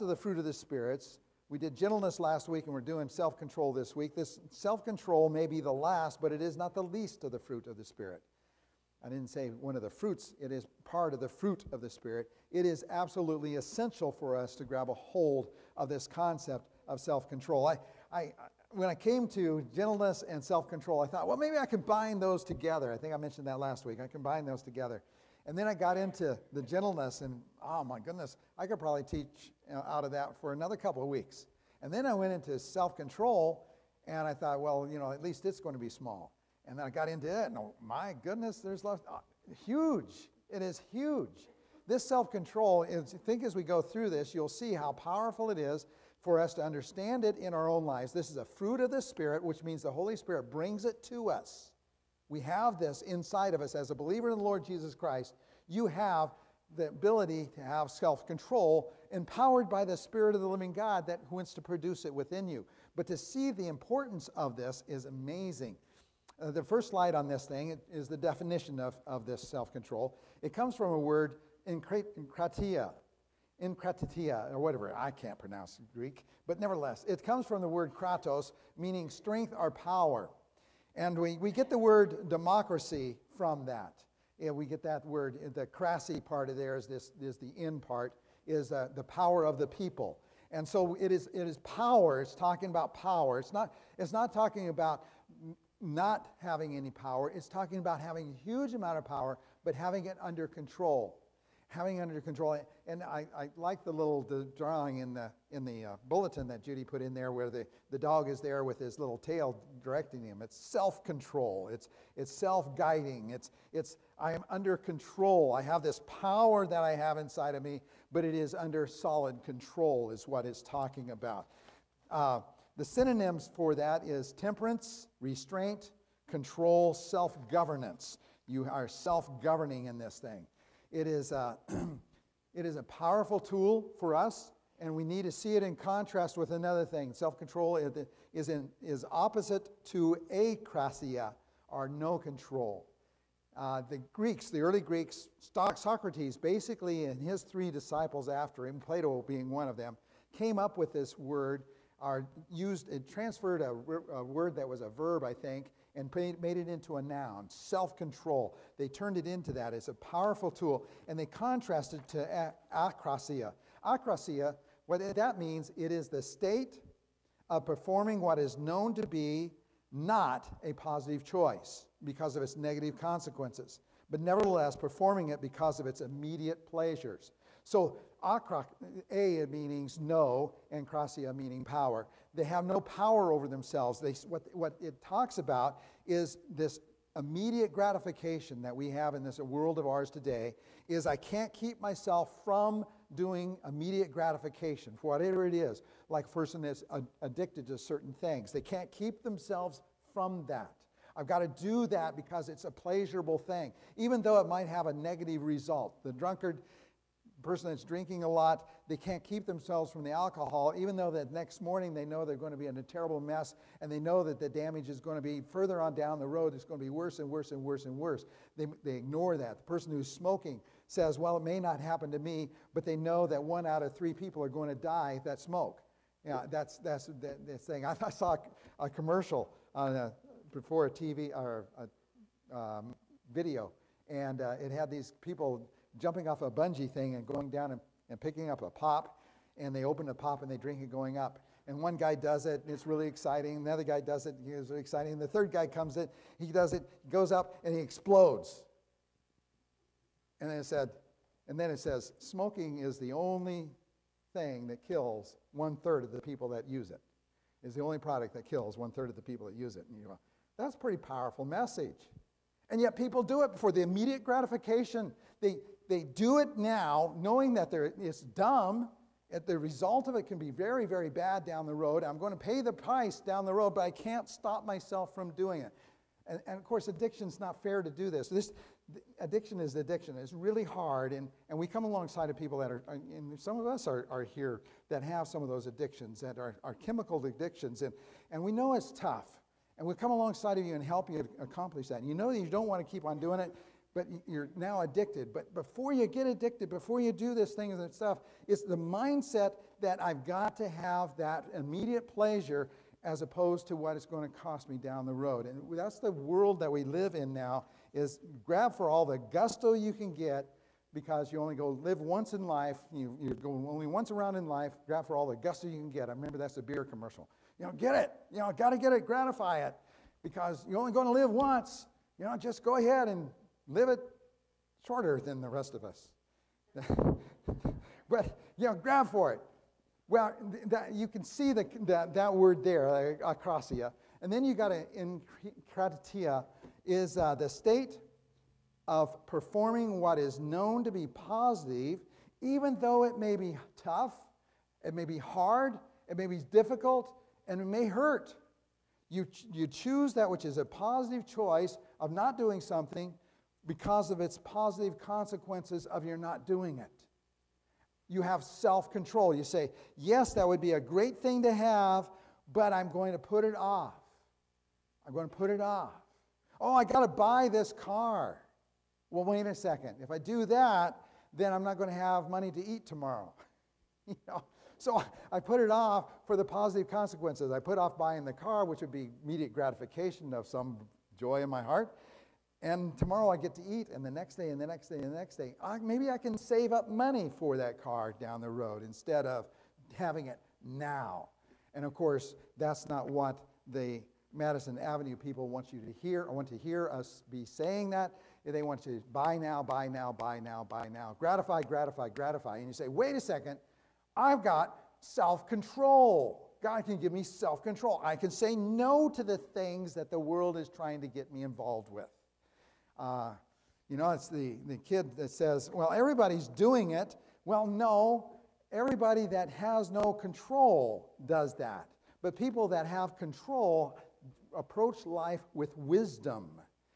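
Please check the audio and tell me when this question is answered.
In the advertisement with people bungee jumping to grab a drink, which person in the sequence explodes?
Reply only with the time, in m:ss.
4:05.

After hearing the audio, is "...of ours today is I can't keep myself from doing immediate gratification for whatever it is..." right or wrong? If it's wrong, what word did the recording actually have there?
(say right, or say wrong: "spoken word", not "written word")
right.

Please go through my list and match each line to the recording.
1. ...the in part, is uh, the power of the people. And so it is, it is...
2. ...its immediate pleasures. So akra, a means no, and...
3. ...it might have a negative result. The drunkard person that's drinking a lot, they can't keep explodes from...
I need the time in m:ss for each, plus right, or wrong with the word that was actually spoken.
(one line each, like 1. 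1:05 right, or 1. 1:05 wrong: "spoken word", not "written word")
1. 1:27 right
2. 2:55 right
3. 3:24 wrong: "themselves", not "explodes".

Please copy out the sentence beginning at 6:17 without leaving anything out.
I put off buying the car, which would be immediate gratification of some joy in my heart.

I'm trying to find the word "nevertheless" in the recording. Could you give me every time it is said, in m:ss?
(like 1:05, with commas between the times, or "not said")
1:16, 2:54.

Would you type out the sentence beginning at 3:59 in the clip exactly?
And they open a pop and they drink it going up.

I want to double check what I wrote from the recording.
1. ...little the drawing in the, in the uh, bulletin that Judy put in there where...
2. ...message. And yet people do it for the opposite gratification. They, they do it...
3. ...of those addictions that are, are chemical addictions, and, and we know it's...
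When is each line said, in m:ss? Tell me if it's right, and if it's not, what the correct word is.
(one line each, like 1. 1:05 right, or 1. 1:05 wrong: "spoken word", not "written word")
1. 1:43 right
2. 4:21 wrong: "immediate", not "opposite"
3. 4:45 right.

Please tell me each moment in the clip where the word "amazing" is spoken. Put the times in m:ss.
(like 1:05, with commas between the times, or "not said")
1:05.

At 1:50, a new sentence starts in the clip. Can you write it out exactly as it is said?
It's self control, it's, it's self guiding, it's, it's I am under control.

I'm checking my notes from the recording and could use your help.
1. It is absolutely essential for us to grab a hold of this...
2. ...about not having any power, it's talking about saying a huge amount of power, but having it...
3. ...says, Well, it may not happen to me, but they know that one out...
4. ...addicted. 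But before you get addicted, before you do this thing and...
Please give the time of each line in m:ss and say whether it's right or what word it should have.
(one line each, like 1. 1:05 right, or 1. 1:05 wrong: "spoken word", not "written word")
1. 0:12 right
2. 1:34 wrong: "having", not "saying"
3. 3:40 right
4. 4:54 right.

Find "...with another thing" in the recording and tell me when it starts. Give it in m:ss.
2:16.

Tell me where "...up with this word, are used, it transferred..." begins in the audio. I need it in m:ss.
2:30.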